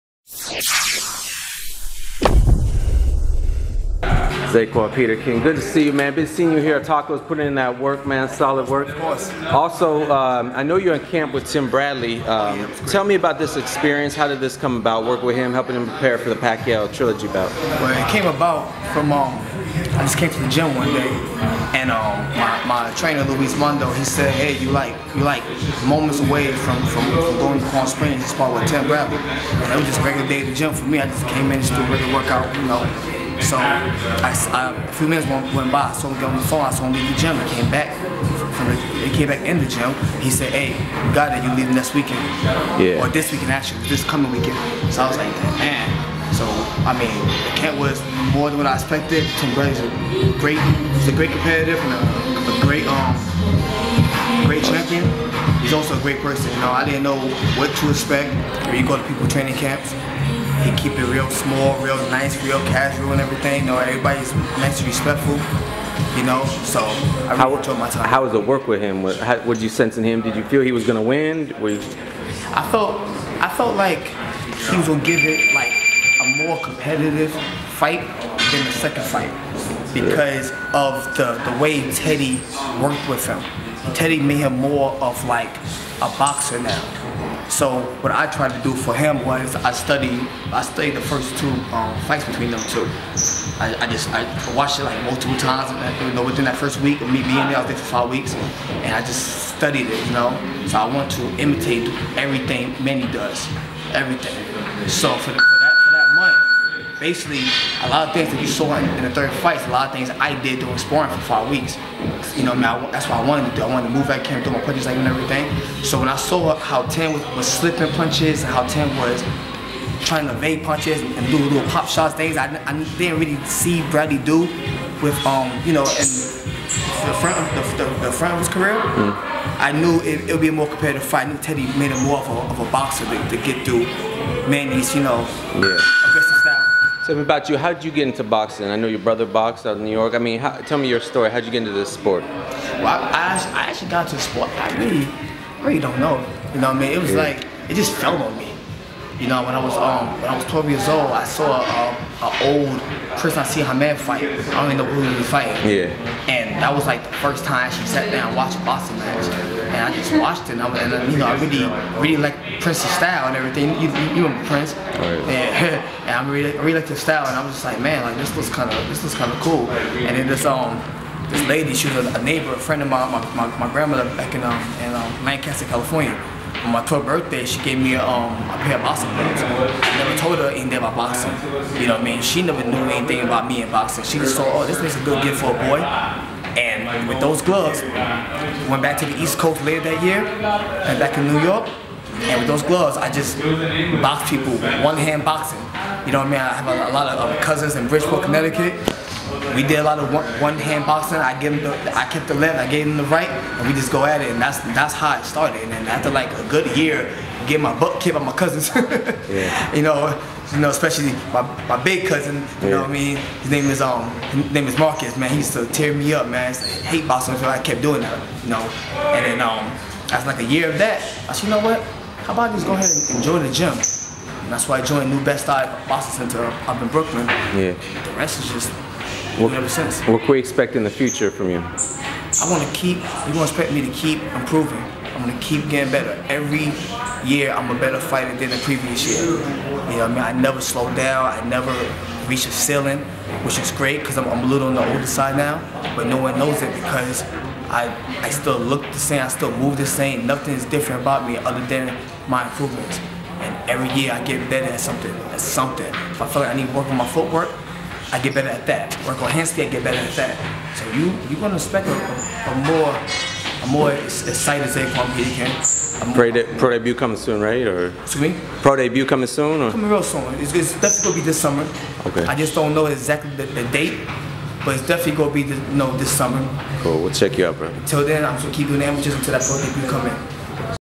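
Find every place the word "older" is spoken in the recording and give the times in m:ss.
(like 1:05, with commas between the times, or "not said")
4:04.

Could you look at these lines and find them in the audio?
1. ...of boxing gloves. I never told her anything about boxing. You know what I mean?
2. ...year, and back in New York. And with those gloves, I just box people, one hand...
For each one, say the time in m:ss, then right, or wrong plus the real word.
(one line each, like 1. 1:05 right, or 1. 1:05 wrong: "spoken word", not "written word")
1. 2:58 right
2. 3:10 right.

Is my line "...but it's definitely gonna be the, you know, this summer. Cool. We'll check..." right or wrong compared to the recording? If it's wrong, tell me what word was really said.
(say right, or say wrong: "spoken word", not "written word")
right.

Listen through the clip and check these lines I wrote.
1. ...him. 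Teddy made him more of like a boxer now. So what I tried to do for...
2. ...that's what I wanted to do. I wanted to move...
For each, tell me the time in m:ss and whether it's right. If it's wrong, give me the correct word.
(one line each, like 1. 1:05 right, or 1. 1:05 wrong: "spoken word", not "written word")
1. 1:23 right
2. 1:52 right.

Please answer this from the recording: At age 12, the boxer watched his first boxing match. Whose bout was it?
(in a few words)
Prince Naseem Hamed.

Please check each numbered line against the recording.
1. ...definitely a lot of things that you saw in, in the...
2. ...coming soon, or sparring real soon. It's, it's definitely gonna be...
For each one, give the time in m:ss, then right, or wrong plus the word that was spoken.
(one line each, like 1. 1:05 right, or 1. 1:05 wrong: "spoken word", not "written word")
1. 1:47 wrong: "basically", not "definitely"
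2. 4:29 wrong: "coming", not "sparring".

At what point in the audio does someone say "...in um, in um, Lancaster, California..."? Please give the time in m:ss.
2:54.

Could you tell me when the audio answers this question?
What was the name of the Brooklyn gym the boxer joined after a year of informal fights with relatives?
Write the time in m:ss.
3:45.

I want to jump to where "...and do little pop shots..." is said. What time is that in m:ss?
2:01.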